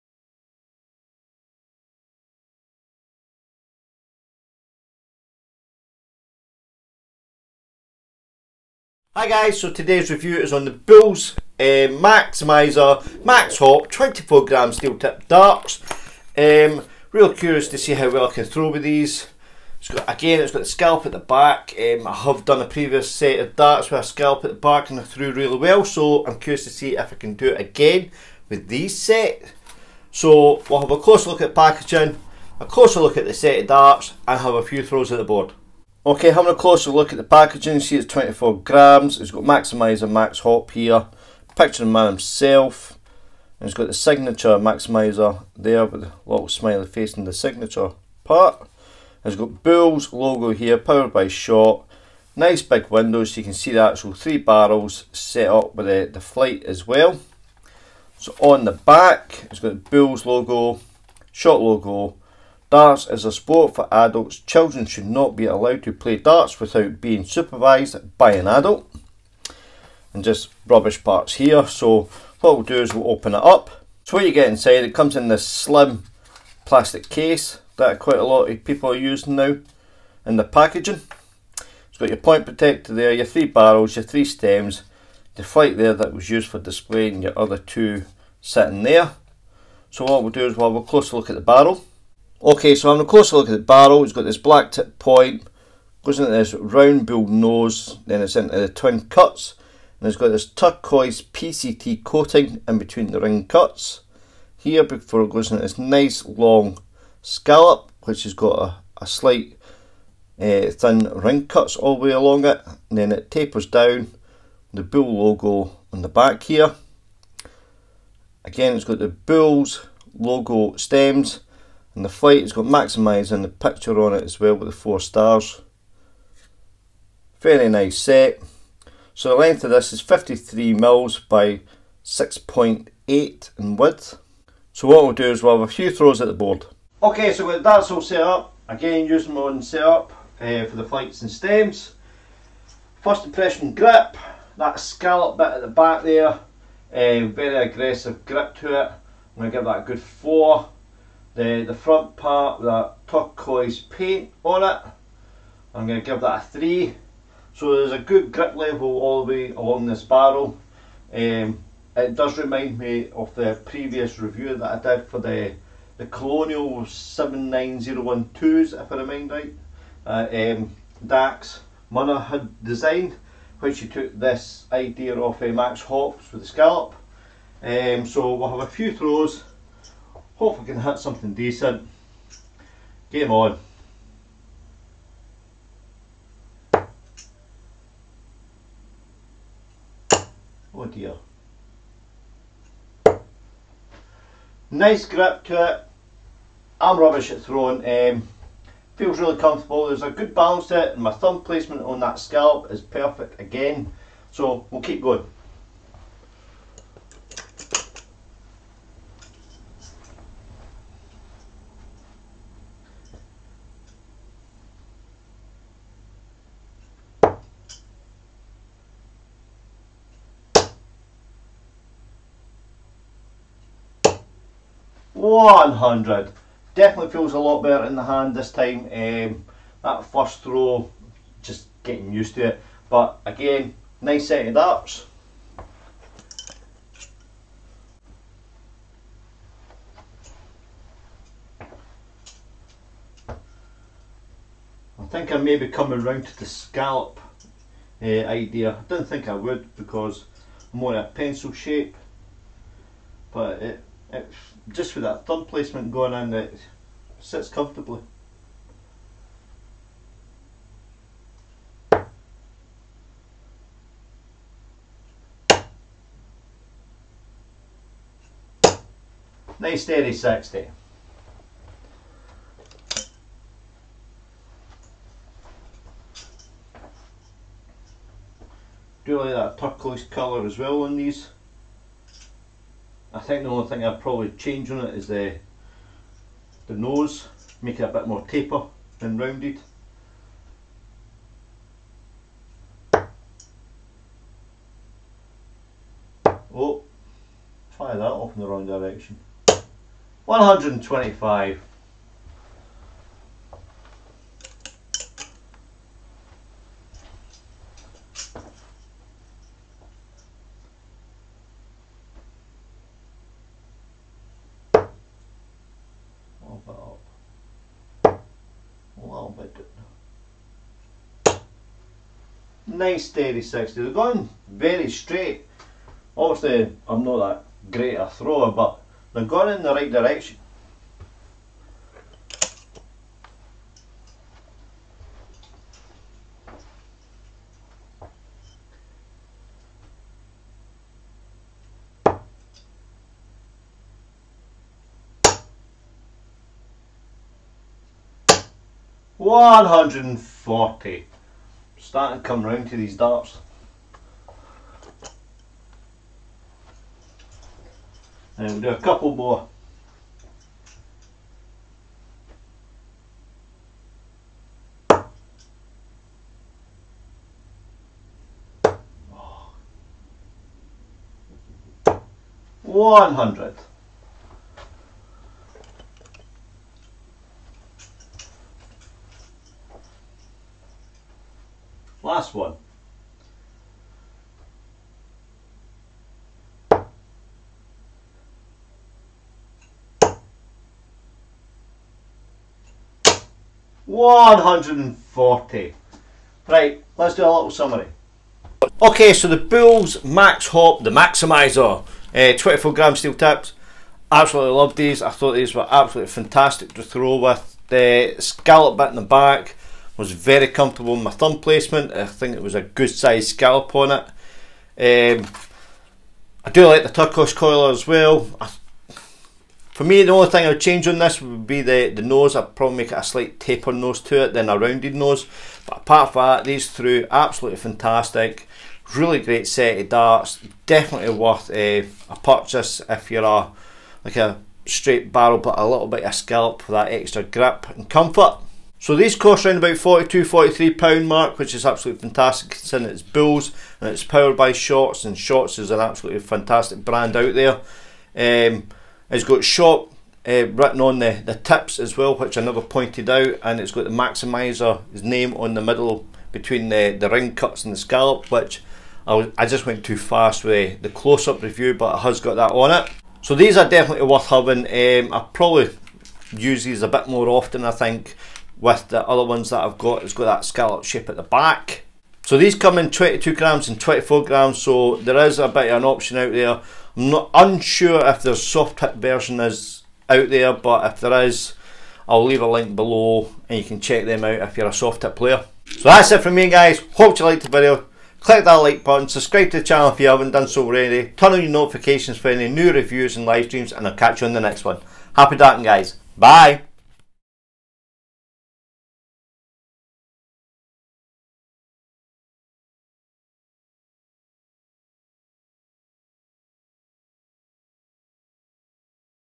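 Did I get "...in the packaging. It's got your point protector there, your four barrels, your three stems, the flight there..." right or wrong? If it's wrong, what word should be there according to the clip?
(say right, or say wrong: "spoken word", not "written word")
wrong: "three", not "four".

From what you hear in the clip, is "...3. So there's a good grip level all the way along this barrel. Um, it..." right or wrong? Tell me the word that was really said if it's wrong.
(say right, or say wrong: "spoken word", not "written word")
right.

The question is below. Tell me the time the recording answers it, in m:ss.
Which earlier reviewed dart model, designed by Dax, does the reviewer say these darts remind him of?
2:46.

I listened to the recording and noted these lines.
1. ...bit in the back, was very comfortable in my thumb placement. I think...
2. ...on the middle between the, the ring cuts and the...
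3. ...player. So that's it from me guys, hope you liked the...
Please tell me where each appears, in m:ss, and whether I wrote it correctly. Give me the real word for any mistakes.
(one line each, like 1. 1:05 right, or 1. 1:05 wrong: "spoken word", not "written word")
1. 6:48 right
2. 7:35 right
3. 8:05 right.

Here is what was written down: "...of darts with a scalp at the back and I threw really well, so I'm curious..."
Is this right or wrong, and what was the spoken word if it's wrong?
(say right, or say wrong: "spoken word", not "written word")
right.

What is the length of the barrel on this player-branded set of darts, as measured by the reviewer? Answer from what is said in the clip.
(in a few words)
53 mm.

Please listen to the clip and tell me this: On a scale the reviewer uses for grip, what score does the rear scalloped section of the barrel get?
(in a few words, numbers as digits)
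4.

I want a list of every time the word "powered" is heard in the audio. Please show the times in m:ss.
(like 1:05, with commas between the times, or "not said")
0:50, 7:24.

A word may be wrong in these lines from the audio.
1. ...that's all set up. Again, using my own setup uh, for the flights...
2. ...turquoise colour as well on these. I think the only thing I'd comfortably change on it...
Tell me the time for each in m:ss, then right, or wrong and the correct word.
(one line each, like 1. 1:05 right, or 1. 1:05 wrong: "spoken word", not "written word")
1. 2:17 right
2. 4:39 wrong: "probably", not "comfortably".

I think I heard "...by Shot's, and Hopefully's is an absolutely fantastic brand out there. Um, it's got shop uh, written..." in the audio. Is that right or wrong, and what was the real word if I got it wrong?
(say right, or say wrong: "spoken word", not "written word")
wrong: "Shot", not "Hopefully".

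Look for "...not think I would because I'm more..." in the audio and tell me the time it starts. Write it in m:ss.
4:08.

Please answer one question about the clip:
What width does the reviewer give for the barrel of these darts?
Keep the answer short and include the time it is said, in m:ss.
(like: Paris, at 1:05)
6.8, at 2:12.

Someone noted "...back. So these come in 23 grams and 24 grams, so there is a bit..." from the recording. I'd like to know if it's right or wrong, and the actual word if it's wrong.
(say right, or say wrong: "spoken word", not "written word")
wrong: "22", not "23".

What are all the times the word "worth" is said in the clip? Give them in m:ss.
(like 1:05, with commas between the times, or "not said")
7:11, 7:44.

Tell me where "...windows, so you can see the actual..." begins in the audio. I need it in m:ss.
0:52.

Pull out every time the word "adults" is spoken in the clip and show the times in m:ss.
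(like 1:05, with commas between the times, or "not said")
1:03, 1:08.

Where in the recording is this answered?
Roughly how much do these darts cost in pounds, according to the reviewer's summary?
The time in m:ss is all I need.
7:19.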